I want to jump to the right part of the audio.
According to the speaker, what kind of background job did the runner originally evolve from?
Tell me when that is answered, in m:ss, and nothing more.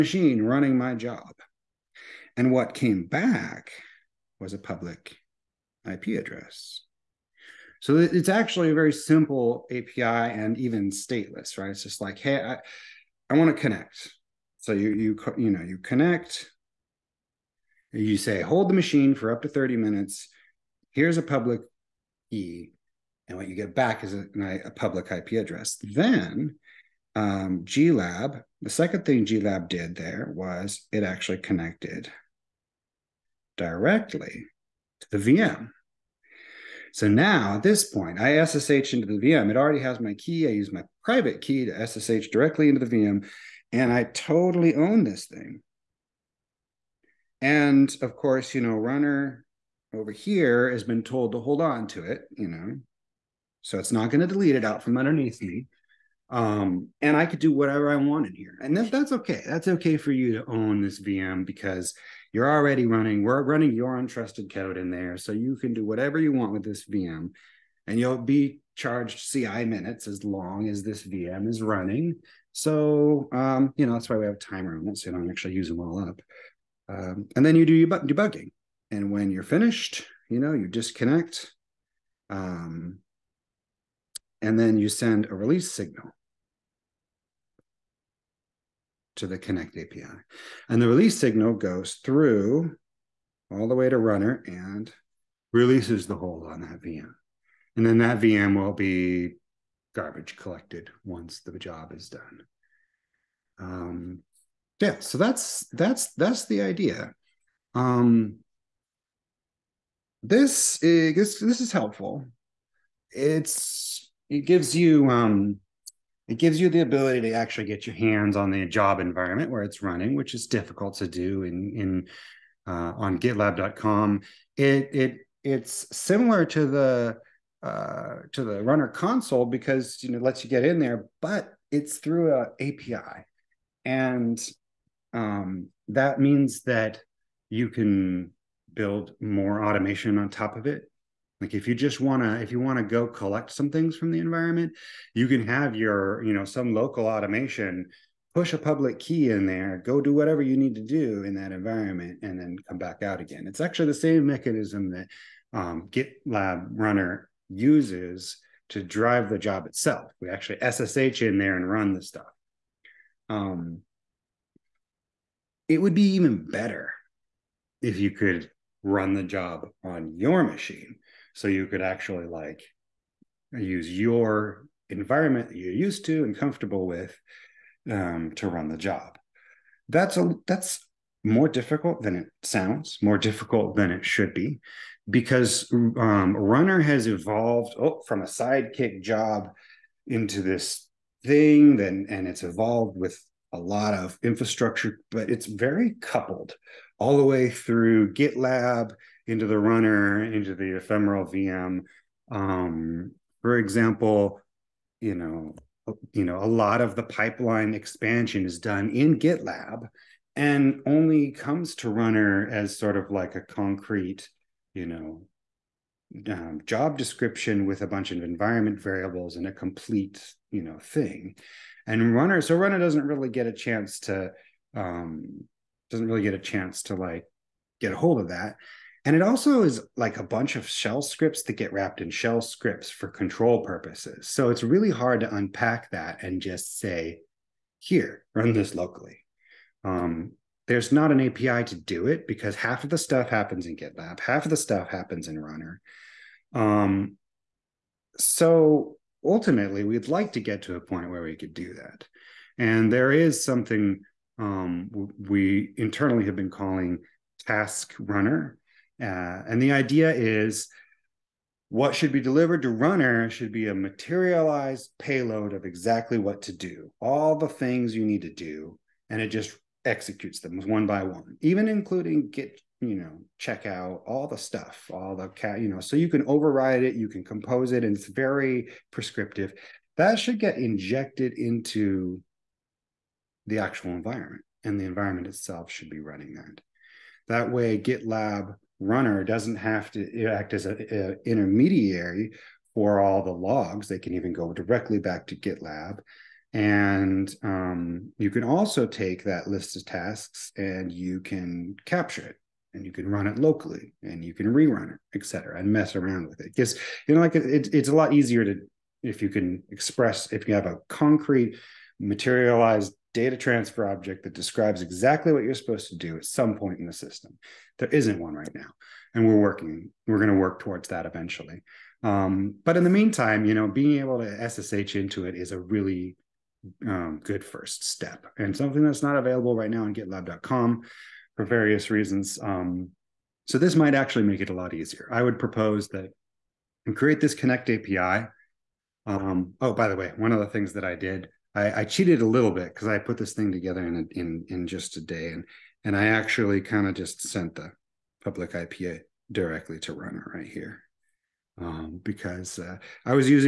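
3:08.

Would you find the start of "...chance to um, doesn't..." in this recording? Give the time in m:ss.
3:43.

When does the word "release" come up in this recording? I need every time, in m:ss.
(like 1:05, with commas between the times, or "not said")
1:25, 1:30, 1:35.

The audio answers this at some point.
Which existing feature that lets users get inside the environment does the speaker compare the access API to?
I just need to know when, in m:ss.
2:08.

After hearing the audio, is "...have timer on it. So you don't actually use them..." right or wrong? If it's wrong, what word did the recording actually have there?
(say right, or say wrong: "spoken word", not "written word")
right.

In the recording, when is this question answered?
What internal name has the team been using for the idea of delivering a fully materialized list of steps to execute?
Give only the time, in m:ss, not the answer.
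4:17.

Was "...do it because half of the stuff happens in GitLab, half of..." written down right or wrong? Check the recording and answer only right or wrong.
right.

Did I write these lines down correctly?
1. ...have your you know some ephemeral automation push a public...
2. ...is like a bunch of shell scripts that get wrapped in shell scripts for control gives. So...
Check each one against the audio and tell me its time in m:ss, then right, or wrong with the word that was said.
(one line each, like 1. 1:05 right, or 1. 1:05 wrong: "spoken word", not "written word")
1. 2:25 wrong: "local", not "ephemeral"
2. 3:49 wrong: "purposes", not "gives".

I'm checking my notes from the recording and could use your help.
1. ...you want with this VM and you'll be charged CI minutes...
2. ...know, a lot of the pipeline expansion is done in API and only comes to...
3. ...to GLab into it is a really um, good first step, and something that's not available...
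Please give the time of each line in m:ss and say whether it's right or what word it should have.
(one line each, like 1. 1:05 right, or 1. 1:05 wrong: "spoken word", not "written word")
1. 1:06 right
2. 3:26 wrong: "GitLab", not "API"
3. 5:24 wrong: "SSH", not "GLab".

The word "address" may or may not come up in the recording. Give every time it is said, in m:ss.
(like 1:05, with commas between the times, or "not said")
0:06, 0:25.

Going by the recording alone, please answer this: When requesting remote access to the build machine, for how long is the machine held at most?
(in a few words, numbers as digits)
30 minutes.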